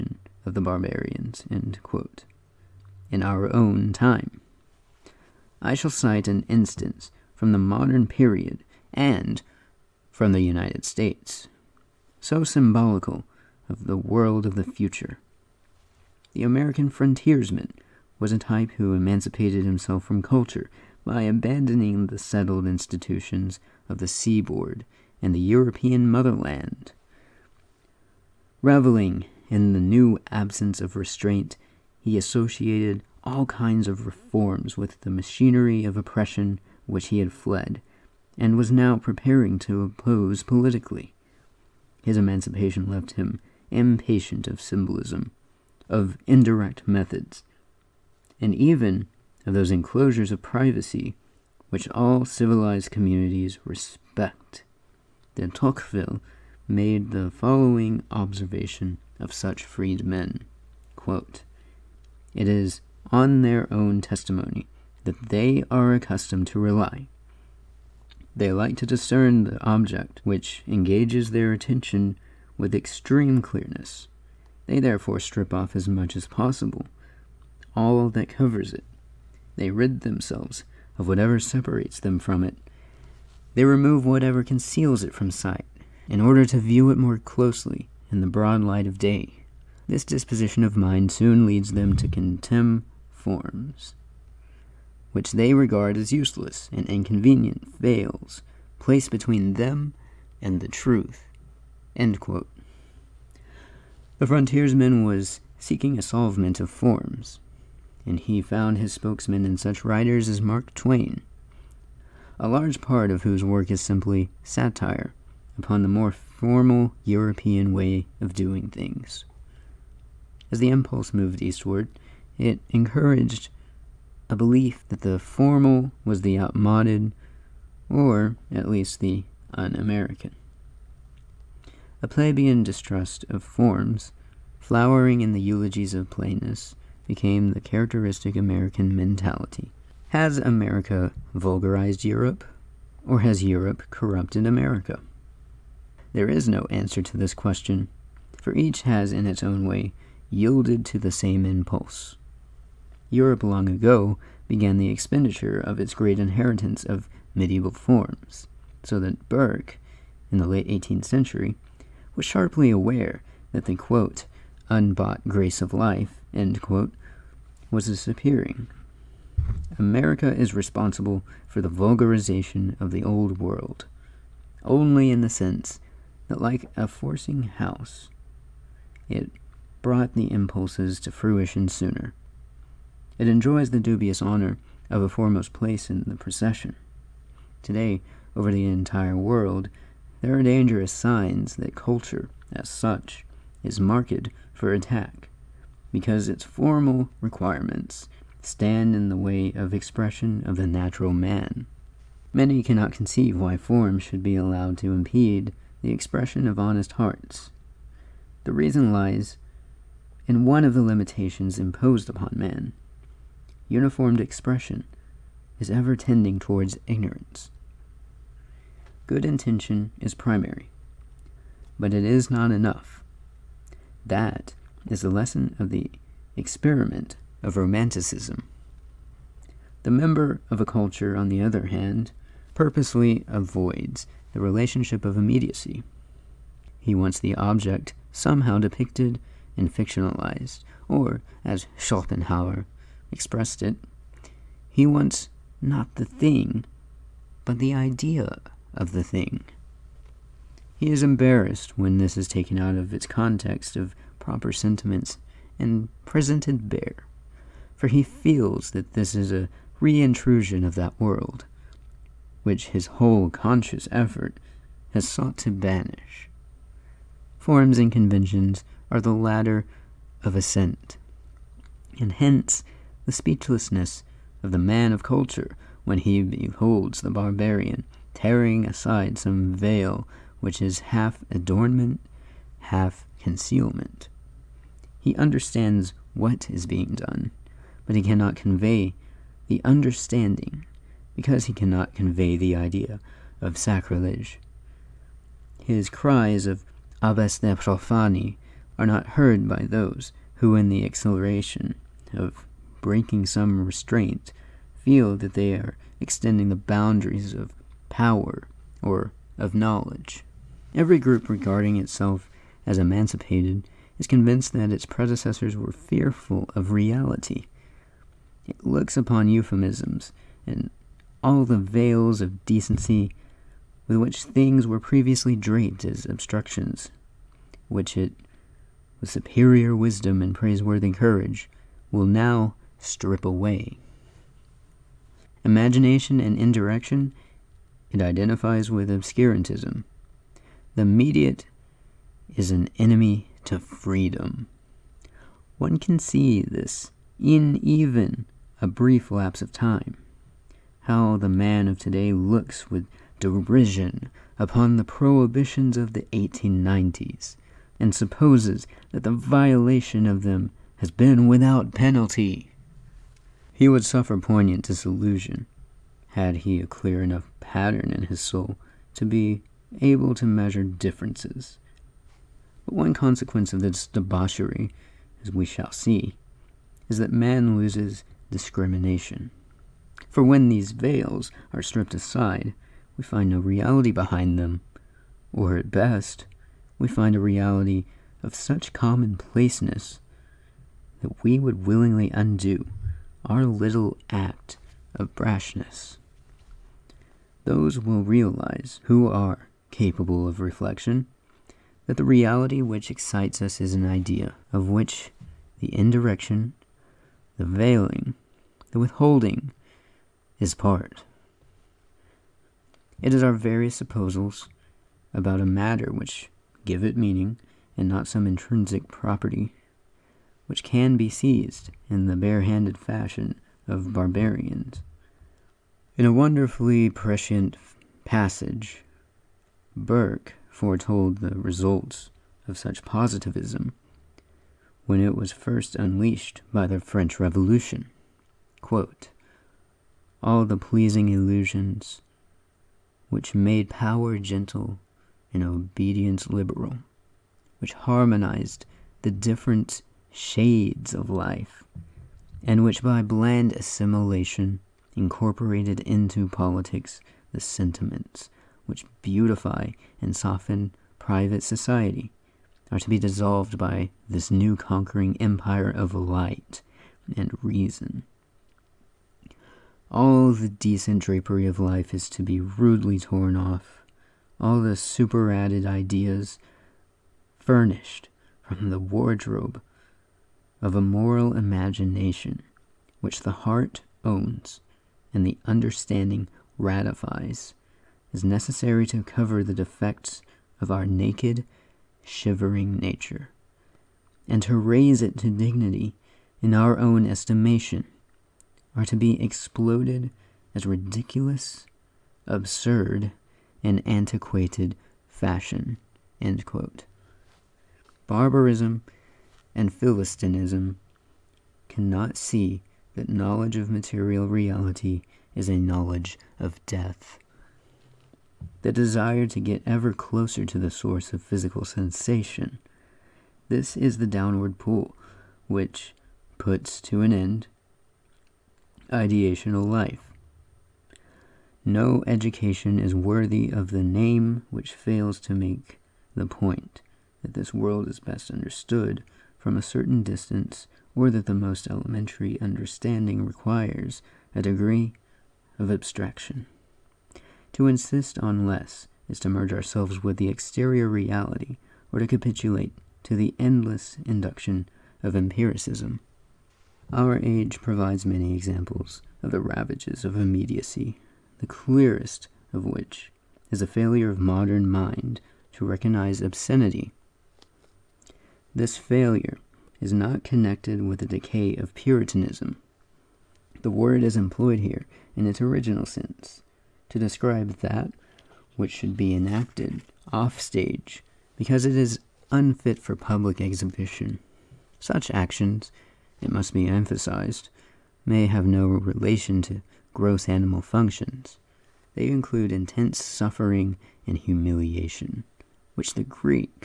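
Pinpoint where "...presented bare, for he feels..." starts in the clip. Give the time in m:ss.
4:16.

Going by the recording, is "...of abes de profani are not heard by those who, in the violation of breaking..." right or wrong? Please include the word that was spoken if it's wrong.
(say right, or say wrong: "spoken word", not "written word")
wrong: "exhilaration", not "violation".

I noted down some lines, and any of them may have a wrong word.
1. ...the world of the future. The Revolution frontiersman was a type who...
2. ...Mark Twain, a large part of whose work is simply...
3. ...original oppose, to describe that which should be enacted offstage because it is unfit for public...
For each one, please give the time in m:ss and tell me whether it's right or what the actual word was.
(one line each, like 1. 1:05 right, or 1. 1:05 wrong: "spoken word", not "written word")
1. 0:13 wrong: "American", not "Revolution"
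2. 1:50 right
3. 9:35 wrong: "sense", not "oppose".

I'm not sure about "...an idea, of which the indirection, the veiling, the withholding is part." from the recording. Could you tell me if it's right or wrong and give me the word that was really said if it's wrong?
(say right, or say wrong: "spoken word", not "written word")
right.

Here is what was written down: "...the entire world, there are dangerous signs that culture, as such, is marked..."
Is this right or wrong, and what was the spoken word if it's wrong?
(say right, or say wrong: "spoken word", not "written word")
right.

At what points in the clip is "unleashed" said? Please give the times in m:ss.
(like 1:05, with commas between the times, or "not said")
7:15.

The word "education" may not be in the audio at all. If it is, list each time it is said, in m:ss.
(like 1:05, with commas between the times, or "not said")
8:52.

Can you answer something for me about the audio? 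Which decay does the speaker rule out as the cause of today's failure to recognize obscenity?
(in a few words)
Puritanism.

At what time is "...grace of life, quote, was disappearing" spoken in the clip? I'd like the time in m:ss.
2:45.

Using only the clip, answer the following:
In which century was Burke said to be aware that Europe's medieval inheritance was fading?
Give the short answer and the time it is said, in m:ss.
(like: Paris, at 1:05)
18th century, at 2:40.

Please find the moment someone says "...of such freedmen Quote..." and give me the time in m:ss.
0:59.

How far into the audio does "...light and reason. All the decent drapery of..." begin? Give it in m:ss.
7:45.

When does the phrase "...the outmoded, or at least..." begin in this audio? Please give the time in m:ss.
2:06.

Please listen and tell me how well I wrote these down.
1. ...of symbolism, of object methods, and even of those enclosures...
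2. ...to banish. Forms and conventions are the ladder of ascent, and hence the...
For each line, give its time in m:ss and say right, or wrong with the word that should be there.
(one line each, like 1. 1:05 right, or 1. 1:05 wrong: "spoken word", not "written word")
1. 0:44 wrong: "indirect", not "object"
2. 4:25 right.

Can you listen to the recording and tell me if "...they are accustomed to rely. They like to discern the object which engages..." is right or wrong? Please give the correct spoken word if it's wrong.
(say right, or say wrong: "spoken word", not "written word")
right.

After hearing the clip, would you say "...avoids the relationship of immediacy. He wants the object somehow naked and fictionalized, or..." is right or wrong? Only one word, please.
wrong.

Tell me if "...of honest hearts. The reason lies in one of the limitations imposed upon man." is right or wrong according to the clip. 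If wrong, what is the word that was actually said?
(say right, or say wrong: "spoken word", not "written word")
right.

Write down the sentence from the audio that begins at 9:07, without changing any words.
To insist on less is to merge ourselves with the exterior reality or to capitulate to the endless induction of empiricism.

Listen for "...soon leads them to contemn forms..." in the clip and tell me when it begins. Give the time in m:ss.
1:31.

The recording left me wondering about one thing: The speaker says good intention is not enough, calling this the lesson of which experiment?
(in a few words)
Romanticism.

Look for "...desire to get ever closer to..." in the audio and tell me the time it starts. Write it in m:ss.
8:38.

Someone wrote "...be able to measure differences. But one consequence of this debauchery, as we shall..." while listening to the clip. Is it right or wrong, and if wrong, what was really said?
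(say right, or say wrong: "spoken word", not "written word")
right.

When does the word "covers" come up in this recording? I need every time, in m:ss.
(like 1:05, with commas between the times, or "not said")
1:18, 8:09.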